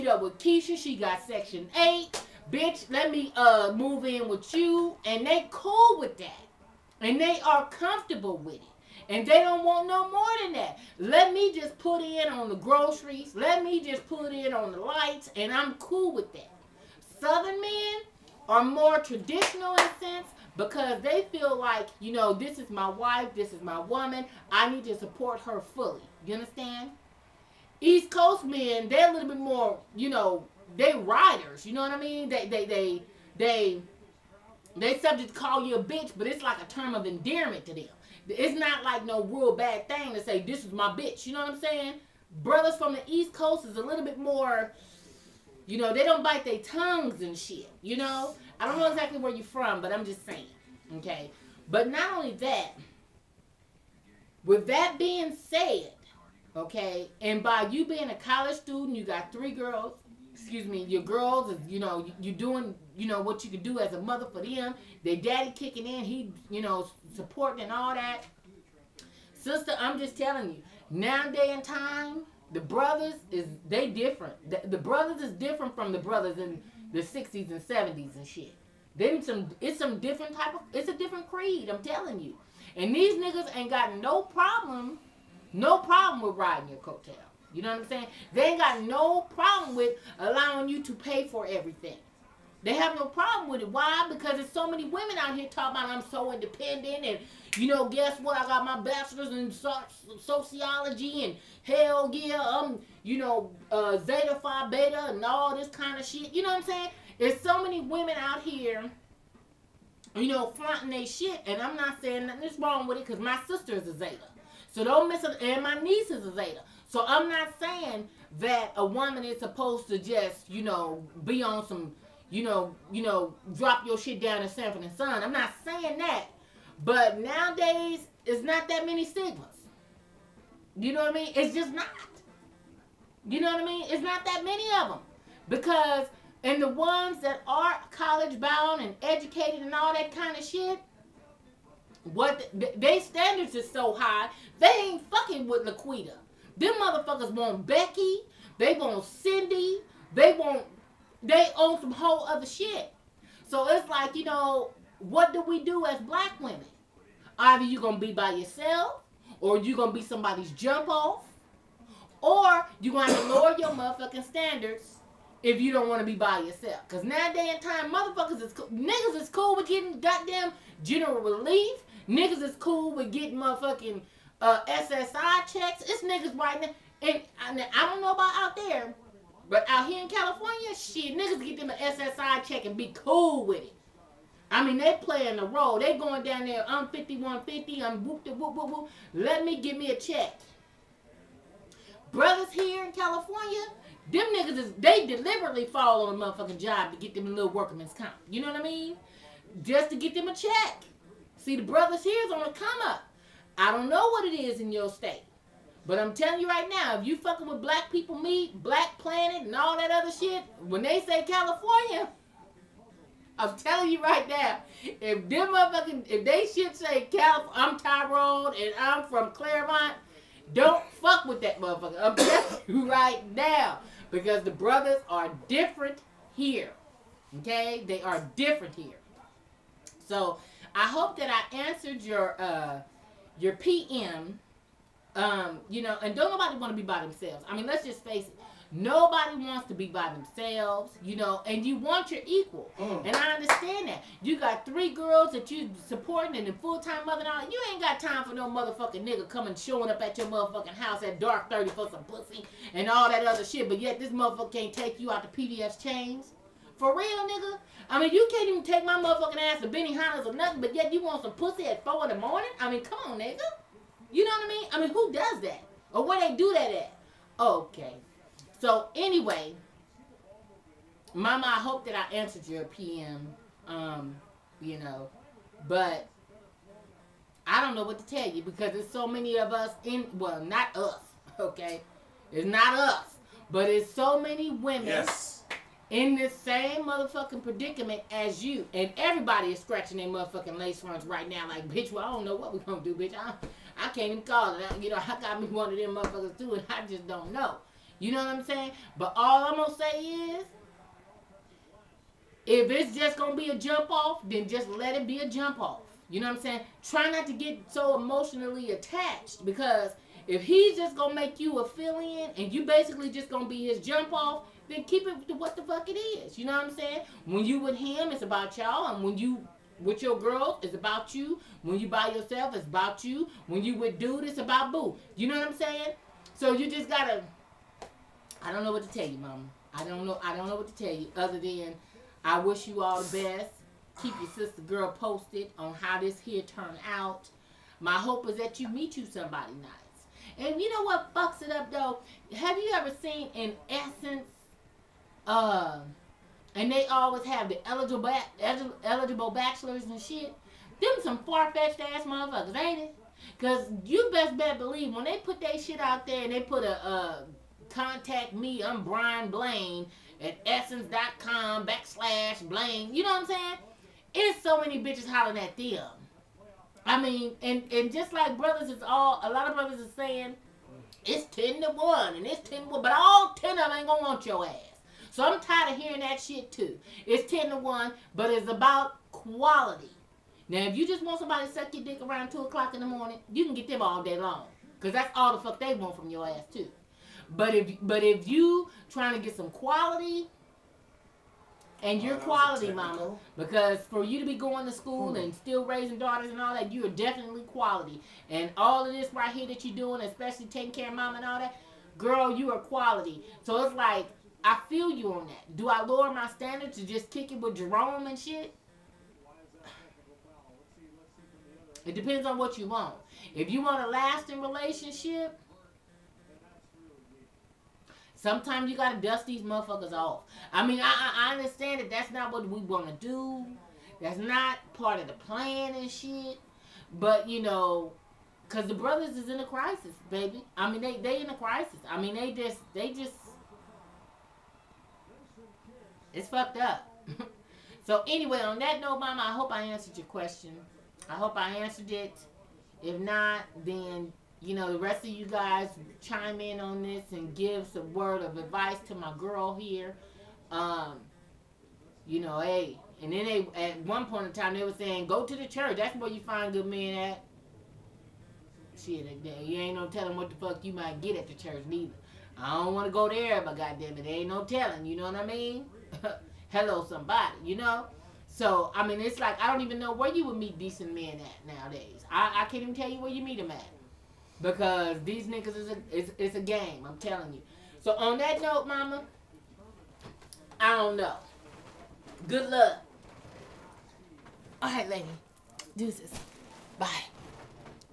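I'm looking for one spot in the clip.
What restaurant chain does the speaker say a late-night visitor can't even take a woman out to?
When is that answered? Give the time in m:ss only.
4:15.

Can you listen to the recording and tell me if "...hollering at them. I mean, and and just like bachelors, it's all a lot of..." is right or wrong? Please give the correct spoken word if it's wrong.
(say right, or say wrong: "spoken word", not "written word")
wrong: "brothers", not "bachelors".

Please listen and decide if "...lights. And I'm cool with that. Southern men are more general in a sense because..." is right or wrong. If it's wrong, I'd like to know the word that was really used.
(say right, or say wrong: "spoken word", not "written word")
wrong: "traditional", not "general".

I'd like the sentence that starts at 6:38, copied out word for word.
And all of this right here that you're doing, especially taking care of mom and all that, girl, you are quality.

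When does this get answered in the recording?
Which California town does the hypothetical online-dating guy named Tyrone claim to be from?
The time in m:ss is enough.
3:39.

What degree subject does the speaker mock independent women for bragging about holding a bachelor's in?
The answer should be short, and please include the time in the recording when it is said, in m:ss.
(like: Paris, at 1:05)
Sociology, at 1:40.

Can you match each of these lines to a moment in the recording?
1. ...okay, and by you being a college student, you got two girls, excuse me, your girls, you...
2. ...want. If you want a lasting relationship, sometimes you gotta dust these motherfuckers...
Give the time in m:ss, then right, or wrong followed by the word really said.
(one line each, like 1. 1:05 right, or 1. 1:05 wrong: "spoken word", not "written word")
1. 0:56 wrong: "three", not "two"
2. 6:52 right.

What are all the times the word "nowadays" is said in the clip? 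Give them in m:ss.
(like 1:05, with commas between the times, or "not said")
2:07, 7:51.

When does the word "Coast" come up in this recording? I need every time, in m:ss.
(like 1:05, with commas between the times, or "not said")
0:28, 0:43.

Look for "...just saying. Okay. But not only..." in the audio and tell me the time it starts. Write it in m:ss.
0:50.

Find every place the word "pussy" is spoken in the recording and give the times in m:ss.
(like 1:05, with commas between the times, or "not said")
4:12, 4:21.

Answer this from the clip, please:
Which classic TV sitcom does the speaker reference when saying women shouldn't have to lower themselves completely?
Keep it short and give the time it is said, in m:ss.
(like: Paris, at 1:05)
Sanford and Son, at 2:04.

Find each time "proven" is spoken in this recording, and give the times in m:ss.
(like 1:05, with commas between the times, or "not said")
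not said.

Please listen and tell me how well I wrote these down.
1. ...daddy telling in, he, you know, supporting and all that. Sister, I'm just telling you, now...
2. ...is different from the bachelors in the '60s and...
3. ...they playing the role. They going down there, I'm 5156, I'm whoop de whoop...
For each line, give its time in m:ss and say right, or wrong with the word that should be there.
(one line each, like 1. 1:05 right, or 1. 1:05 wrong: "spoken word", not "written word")
1. 1:05 wrong: "kicking", not "telling"
2. 1:15 wrong: "brothers", not "bachelors"
3. 3:04 wrong: "5150", not "5156".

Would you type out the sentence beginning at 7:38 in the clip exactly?
Shit, you ain't no telling what the fuck you might get at the church neither.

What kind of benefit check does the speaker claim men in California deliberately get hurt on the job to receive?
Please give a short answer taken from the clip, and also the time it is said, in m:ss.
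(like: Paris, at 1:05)
Workman's comp, at 3:17.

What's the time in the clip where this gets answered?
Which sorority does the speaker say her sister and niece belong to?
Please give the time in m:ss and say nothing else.
1:43.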